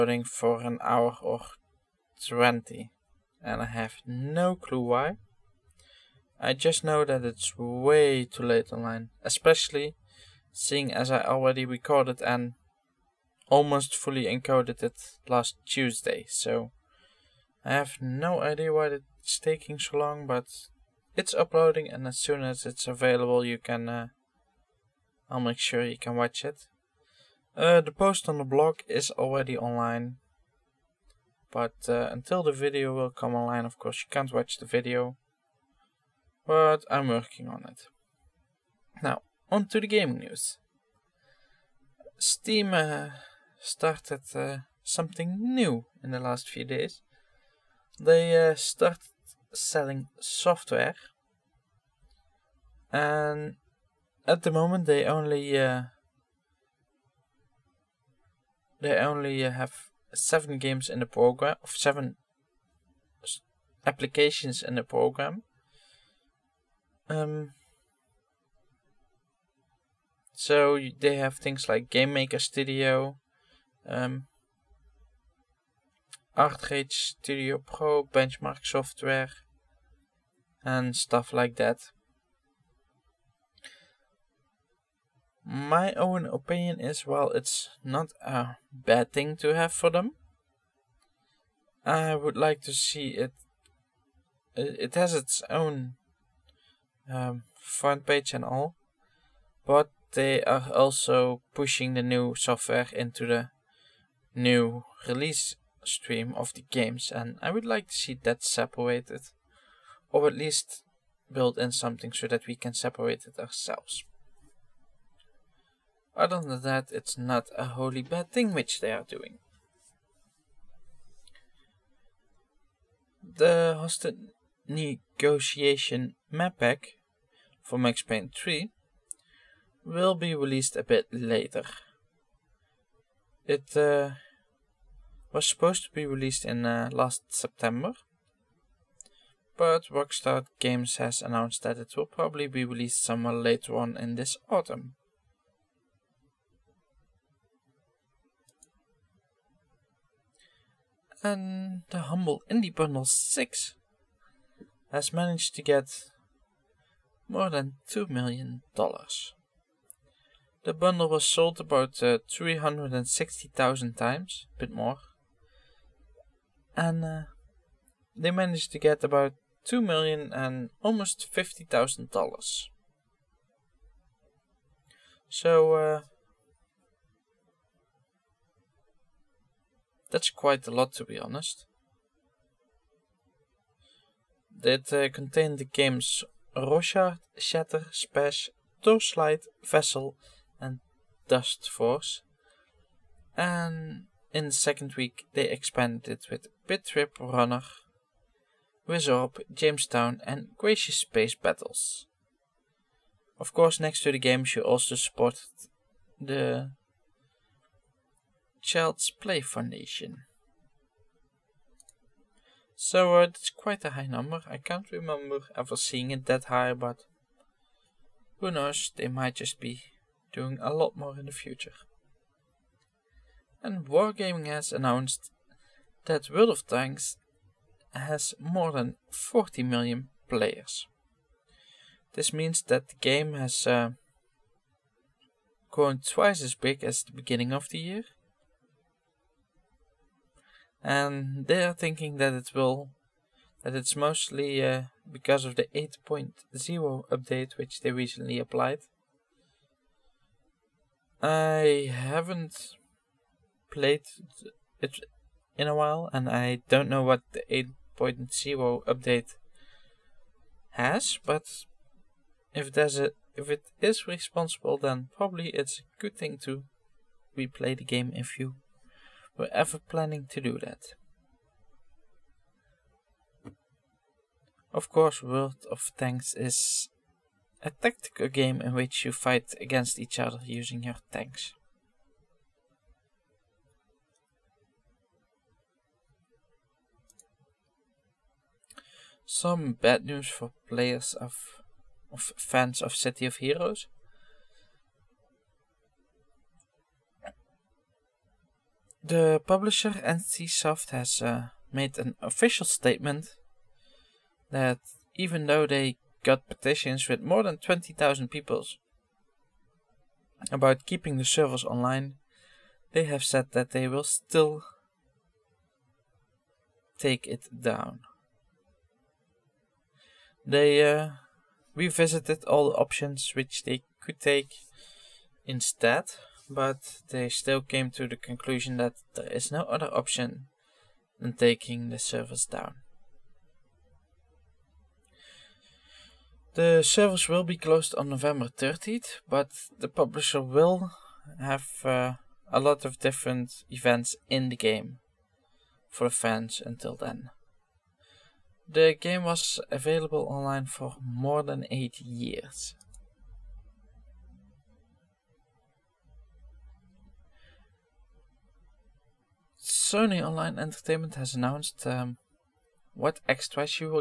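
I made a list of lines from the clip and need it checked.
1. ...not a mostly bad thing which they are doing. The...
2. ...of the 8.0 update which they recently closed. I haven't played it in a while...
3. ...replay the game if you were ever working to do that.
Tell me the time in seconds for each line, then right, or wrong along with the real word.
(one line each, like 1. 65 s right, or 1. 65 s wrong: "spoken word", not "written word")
1. 117 s wrong: "wholly", not "mostly"
2. 245 s wrong: "applied", not "closed"
3. 267 s wrong: "planning", not "working".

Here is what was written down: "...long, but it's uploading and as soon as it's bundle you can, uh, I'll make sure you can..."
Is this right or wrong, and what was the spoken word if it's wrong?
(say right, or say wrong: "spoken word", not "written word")
wrong: "available", not "bundle".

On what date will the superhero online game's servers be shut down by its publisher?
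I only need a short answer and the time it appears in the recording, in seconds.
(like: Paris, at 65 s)
November 30th, at 338 s.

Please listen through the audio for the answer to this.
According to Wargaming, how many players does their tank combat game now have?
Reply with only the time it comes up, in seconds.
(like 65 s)
229 s.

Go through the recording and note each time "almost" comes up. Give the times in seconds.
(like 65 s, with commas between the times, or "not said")
13 s, 170 s.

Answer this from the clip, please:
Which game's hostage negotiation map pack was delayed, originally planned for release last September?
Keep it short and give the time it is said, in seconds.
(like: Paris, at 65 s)
Max Payne 3, at 127 s.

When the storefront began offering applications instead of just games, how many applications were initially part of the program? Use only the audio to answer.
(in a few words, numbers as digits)
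7.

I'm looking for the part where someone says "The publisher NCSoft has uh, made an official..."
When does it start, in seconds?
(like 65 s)
299 s.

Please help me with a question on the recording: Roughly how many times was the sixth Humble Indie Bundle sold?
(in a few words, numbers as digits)
360,000.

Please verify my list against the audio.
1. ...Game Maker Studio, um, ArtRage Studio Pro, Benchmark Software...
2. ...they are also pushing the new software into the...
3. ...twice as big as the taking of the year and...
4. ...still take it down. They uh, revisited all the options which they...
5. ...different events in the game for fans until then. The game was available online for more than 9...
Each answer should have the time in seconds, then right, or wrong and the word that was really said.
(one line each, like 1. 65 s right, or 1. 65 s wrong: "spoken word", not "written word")
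1. 71 s right
2. 100 s right
3. 236 s wrong: "beginning", not "taking"
4. 314 s right
5. 342 s wrong: "8", not "9".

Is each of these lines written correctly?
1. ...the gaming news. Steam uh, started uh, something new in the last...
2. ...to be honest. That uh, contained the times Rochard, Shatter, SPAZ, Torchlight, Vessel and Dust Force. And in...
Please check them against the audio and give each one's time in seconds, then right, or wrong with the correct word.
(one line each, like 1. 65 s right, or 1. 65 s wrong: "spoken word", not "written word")
1. 39 s right
2. 180 s wrong: "games", not "times".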